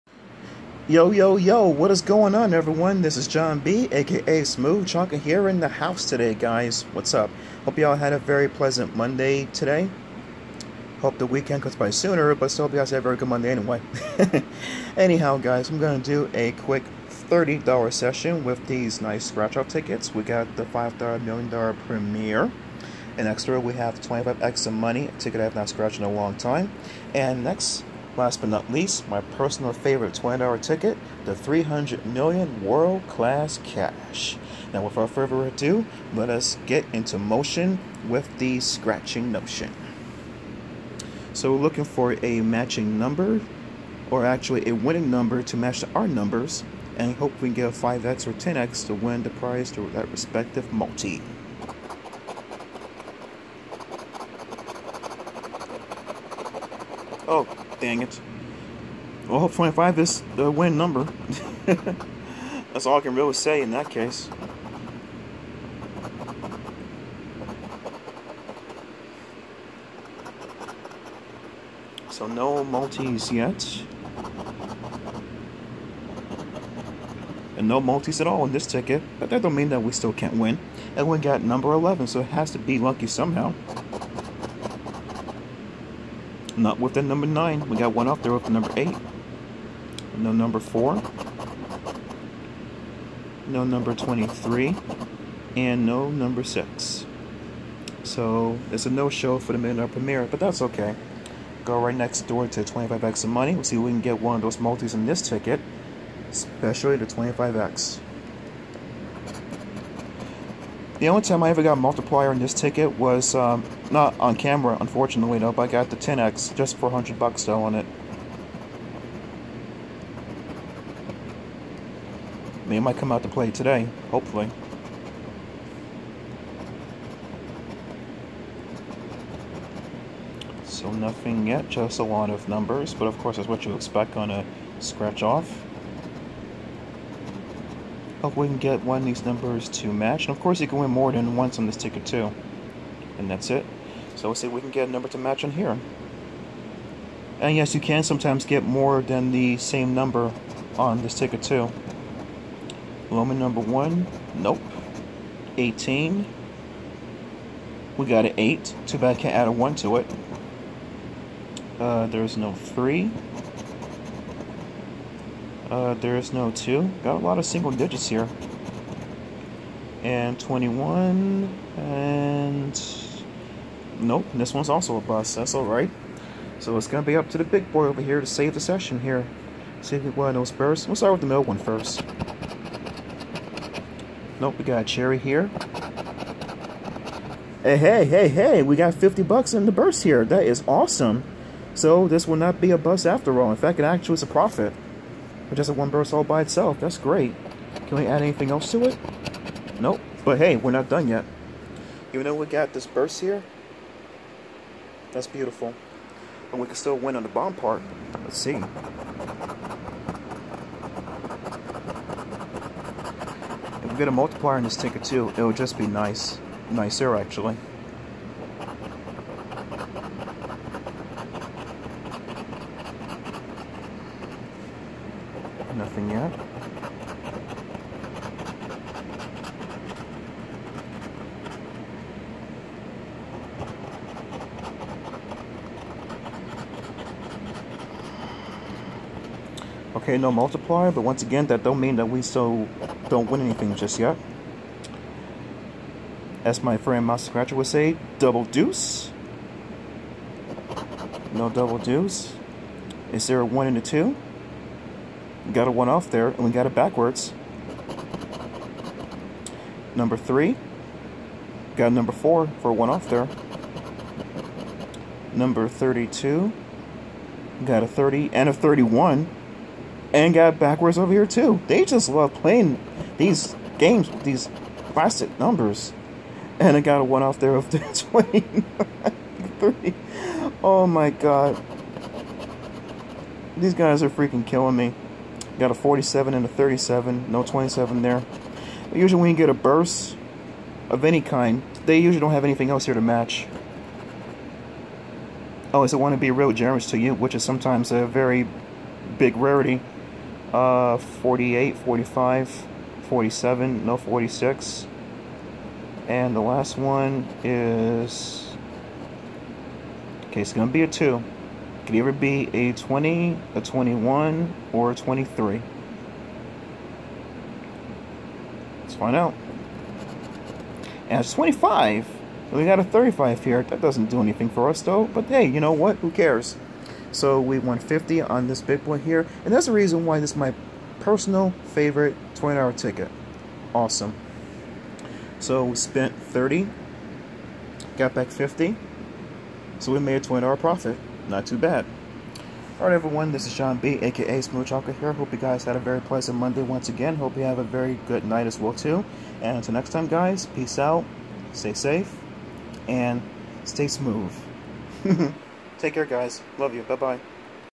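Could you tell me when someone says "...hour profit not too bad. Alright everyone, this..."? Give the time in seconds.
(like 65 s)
340 s.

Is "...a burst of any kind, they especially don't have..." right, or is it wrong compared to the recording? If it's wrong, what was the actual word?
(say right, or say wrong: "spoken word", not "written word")
wrong: "usually", not "especially".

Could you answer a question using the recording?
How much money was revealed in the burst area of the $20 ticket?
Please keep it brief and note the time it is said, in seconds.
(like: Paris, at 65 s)
50 bucks, at 188 s.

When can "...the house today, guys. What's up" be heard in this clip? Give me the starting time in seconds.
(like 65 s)
5 s.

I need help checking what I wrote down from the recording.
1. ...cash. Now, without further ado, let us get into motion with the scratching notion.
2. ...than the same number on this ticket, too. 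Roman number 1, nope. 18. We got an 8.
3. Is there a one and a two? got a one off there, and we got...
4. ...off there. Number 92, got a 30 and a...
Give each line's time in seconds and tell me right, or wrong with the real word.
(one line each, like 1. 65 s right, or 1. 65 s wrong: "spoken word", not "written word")
1. 33 s right
2. 149 s right
3. 253 s right
4. 262 s wrong: "32", not "92".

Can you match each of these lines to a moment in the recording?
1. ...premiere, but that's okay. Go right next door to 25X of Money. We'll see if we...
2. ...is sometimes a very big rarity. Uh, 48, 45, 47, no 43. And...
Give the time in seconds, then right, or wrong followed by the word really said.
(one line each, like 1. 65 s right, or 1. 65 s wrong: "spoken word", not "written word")
1. 99 s right
2. 297 s wrong: "46", not "43".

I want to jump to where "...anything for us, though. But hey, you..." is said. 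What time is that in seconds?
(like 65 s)
324 s.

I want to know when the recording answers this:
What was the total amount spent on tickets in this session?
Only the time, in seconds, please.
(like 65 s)
335 s.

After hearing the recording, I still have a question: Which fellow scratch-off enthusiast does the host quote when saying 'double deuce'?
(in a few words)
Master Scratcher.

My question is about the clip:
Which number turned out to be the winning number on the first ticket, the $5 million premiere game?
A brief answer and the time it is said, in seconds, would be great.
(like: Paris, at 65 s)
25, at 59 s.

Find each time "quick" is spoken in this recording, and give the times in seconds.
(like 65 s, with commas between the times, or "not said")
16 s.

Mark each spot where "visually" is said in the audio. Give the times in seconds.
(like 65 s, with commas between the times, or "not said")
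not said.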